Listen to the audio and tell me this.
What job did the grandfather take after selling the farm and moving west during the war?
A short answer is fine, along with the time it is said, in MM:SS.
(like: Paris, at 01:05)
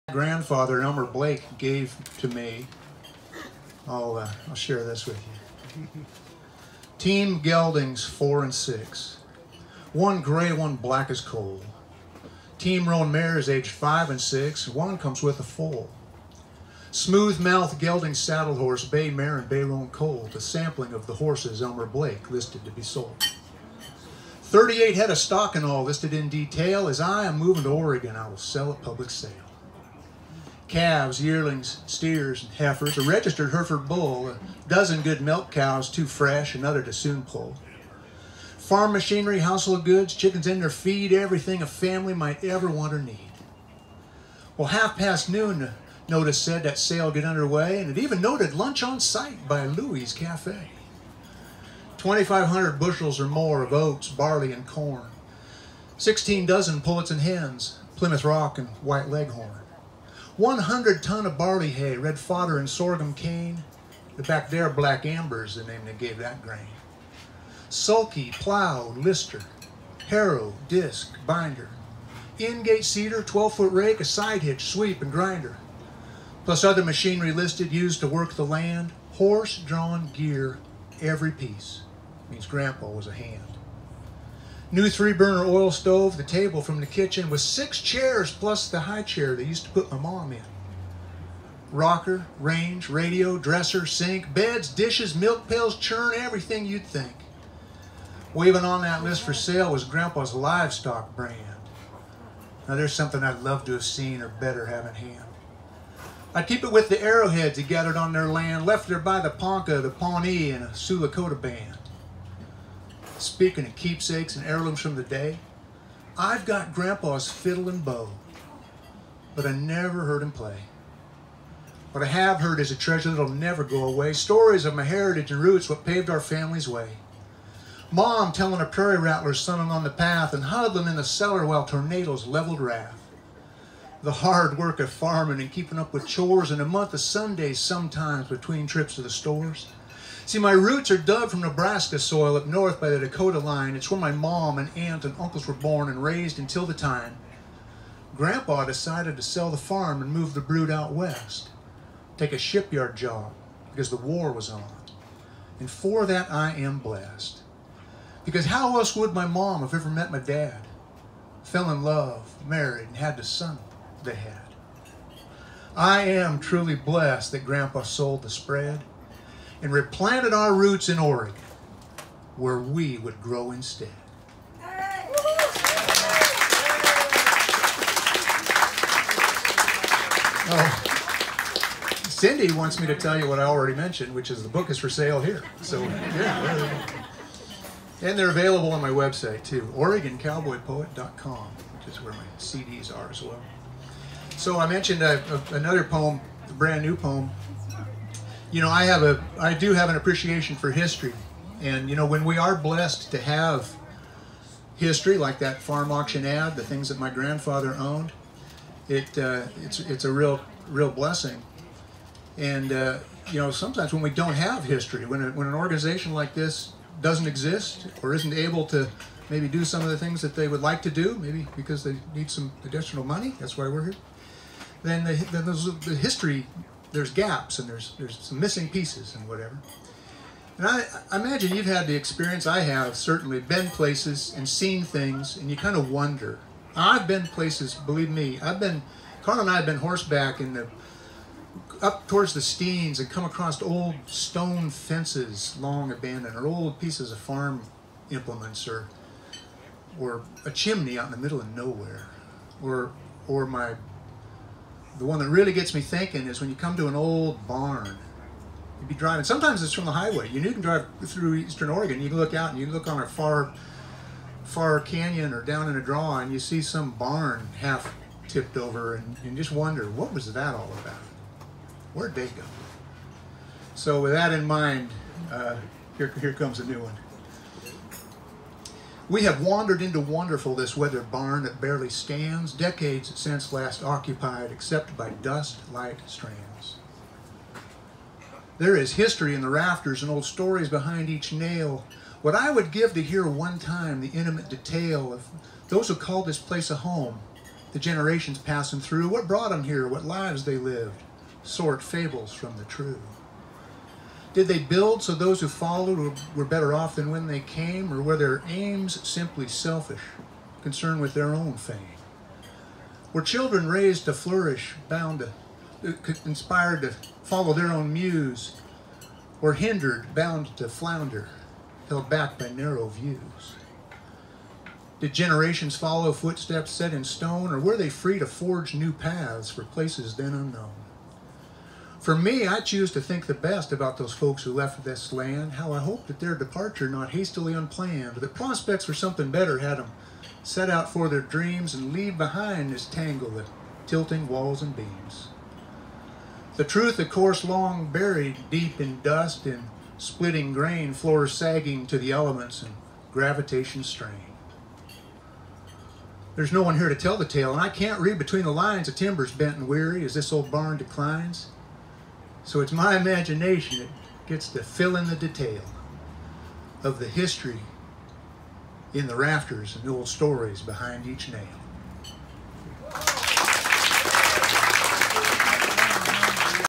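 shipyard job, at 02:32.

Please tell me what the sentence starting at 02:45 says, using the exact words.
I am truly blessed that Grandpa sold the spread and replanted our roots in Oregon, where we would grow instead.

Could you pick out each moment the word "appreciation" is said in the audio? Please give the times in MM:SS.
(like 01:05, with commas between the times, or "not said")
03:19.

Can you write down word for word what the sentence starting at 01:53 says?
Speaking of keepsakes and heirlooms from the day, I've got Grandpa's fiddle and bow, but I never heard him play.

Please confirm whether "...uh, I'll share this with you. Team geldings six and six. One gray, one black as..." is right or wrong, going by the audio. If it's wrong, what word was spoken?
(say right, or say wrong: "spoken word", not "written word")
wrong: "four", not "six".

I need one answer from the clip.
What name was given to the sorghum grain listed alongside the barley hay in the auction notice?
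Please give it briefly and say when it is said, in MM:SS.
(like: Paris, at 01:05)
black amber, at 01:04.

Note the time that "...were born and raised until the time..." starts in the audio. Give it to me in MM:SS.
02:25.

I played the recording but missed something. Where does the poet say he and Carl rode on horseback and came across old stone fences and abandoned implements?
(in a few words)
the Steens.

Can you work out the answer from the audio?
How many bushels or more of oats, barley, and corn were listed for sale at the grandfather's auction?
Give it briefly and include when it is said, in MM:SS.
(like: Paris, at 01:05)
2,500, at 00:51.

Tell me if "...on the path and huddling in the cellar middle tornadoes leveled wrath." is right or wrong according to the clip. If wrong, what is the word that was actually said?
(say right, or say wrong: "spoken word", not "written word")
wrong: "while", not "middle".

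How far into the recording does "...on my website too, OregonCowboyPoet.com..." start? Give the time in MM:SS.
03:08.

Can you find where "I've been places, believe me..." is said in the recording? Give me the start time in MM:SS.
03:56.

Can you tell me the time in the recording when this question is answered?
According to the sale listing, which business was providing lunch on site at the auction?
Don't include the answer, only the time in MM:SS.
00:49.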